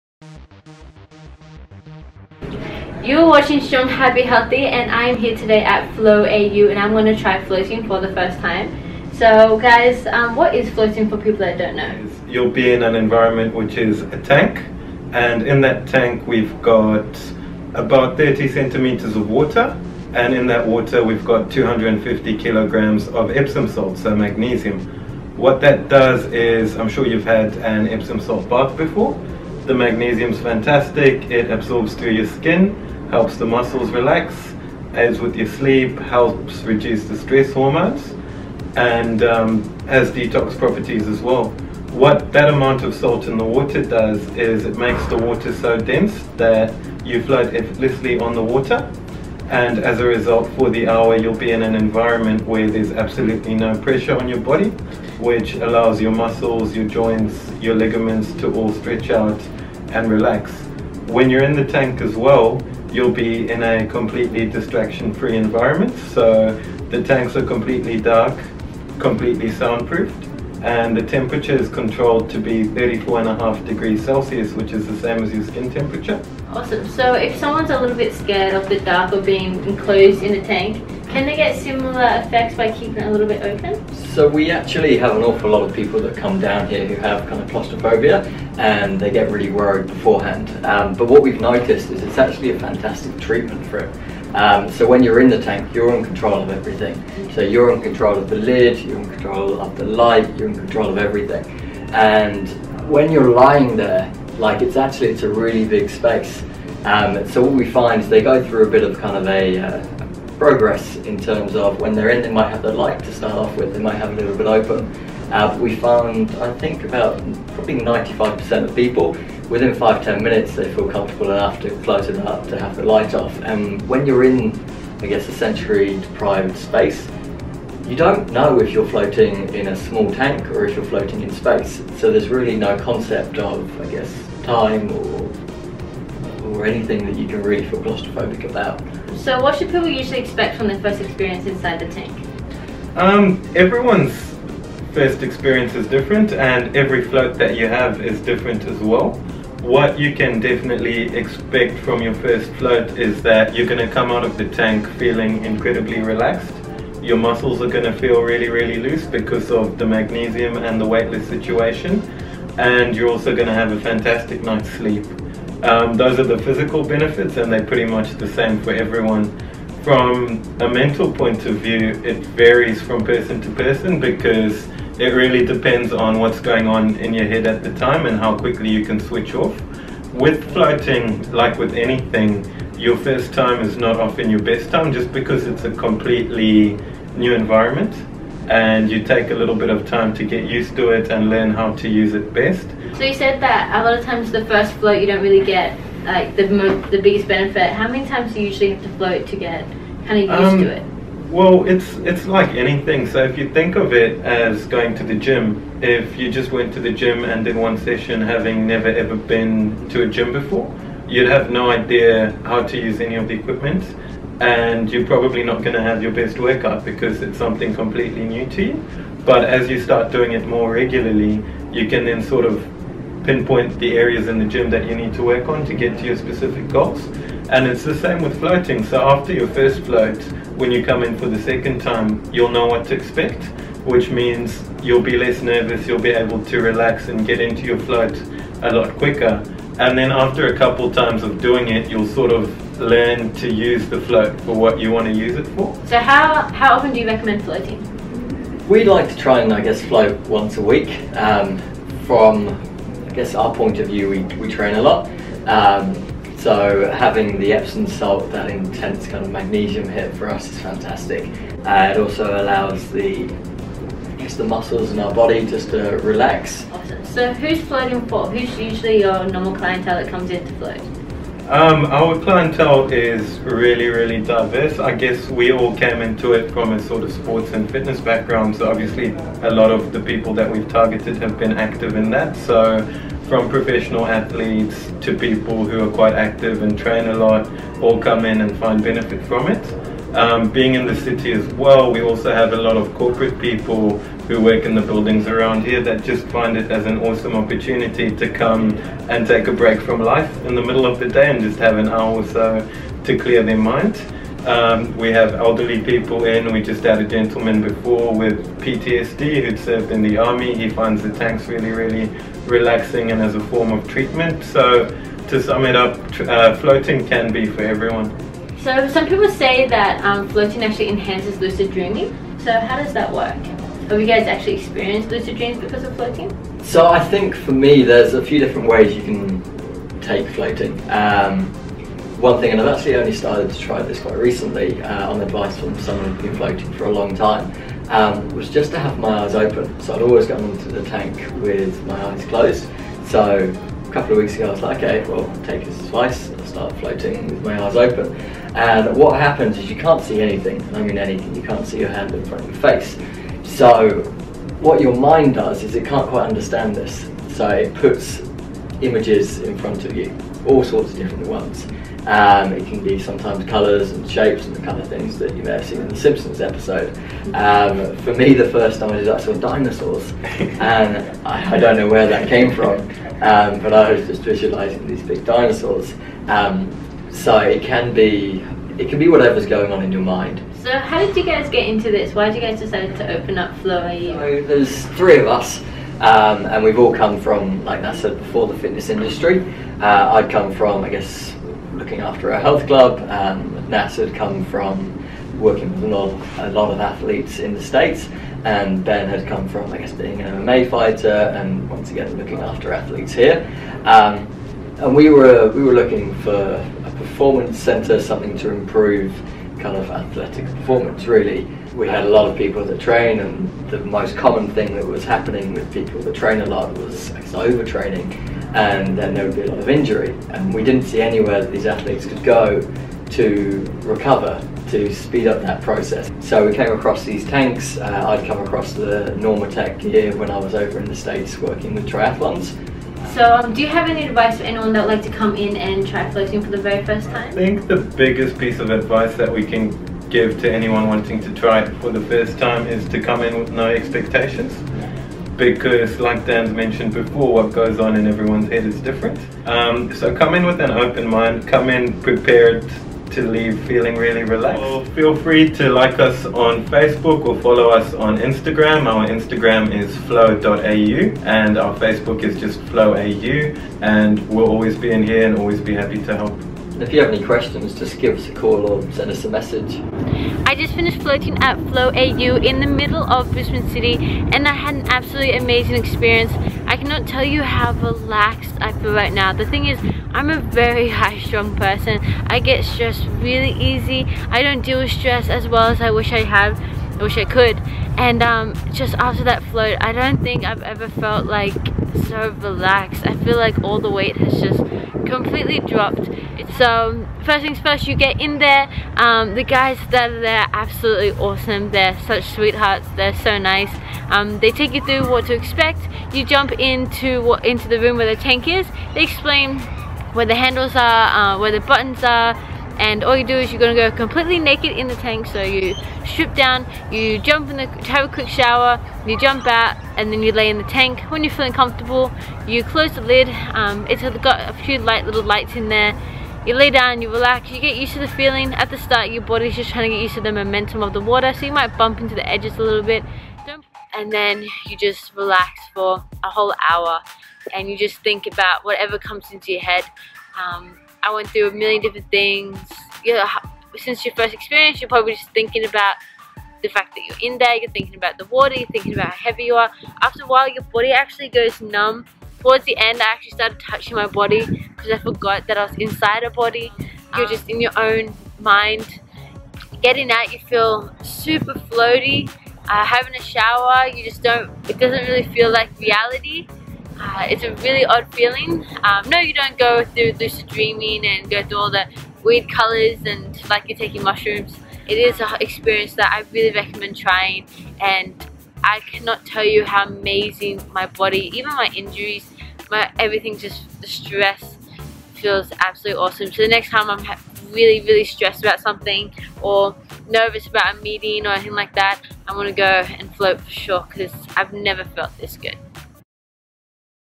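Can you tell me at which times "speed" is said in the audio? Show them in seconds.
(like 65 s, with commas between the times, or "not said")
424 s.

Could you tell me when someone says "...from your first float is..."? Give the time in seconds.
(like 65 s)
151 s.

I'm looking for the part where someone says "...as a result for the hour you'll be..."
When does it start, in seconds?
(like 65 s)
49 s.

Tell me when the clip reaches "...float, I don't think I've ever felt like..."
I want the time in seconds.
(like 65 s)
489 s.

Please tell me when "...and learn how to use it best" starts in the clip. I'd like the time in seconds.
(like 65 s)
191 s.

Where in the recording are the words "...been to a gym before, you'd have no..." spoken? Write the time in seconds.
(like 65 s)
209 s.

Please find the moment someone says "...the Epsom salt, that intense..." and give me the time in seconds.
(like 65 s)
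257 s.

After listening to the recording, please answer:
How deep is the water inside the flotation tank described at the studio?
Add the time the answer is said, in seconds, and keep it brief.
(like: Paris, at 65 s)
30 centimeters, at 18 s.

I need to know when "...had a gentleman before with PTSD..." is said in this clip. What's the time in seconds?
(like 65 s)
306 s.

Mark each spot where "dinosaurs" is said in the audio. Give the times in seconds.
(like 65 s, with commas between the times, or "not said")
369 s, 375 s.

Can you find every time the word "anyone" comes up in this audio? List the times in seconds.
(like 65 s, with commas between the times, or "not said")
434 s, 440 s.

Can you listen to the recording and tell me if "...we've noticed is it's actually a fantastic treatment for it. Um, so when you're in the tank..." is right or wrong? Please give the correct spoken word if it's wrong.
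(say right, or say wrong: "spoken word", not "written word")
right.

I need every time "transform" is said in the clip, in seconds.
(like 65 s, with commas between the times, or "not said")
not said.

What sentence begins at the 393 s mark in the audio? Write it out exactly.
Um, had come from working with a lot, a lot of athletes in the States.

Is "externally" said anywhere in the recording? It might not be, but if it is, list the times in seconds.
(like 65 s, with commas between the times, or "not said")
not said.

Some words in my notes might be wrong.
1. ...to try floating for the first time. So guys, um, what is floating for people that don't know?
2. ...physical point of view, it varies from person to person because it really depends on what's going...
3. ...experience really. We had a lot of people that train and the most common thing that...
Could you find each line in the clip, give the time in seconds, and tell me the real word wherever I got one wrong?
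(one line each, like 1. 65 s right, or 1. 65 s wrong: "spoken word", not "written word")
1. 7 s right
2. 170 s wrong: "mental", not "physical"
3. 410 s wrong: "performance", not "experience".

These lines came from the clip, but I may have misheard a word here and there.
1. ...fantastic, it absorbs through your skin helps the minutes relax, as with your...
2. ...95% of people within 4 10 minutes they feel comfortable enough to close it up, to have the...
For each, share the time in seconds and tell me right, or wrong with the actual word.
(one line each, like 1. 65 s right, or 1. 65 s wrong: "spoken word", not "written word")
1. 30 s wrong: "muscles", not "minutes"
2. 117 s wrong: "5", not "4".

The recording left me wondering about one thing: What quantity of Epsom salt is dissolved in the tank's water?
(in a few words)
250 kilograms.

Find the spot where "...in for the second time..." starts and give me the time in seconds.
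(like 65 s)
231 s.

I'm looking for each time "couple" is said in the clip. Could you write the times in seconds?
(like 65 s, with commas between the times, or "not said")
240 s, 343 s.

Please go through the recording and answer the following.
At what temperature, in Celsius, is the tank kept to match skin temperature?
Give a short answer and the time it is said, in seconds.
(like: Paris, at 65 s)
34.5 degrees, at 72 s.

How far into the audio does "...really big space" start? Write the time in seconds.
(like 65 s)
105 s.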